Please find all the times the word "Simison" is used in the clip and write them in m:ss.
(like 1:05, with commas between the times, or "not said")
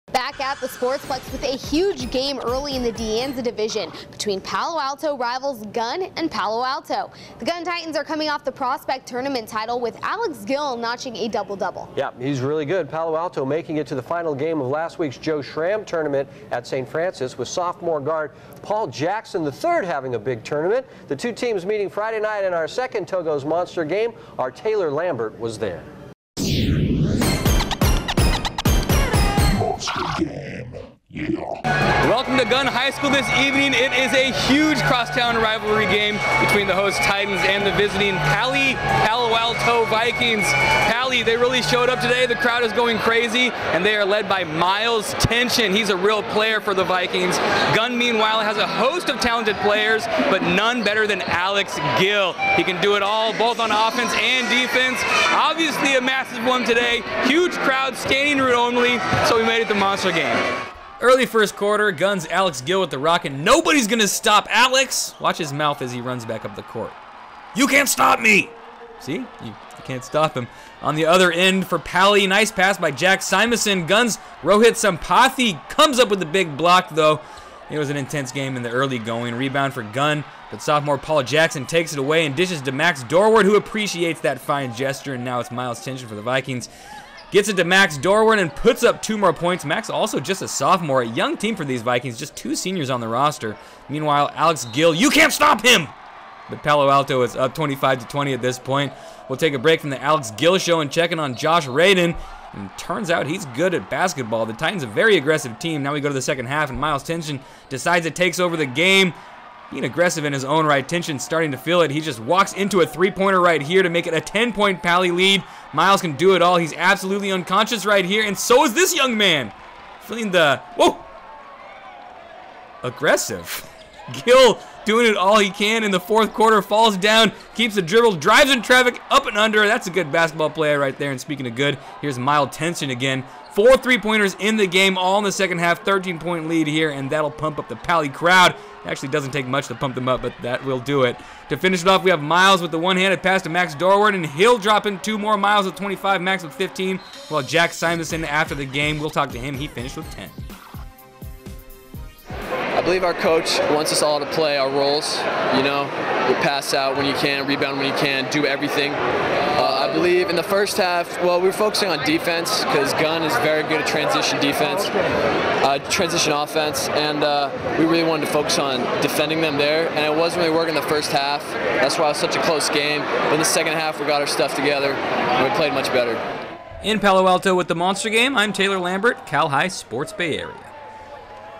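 1:13, 2:27.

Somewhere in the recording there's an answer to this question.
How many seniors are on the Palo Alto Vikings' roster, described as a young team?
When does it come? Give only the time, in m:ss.
1:32.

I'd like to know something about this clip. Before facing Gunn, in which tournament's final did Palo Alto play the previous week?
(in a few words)
Joe Schramm tournament.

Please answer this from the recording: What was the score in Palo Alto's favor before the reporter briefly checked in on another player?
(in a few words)
25 to 20.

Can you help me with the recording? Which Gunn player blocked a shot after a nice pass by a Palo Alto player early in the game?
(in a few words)
Rohit Sampathi.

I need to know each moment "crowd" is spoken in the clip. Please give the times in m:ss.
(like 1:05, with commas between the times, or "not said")
0:42, 0:57, 2:18.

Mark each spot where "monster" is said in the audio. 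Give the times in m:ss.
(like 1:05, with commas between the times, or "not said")
0:23, 0:59, 2:57.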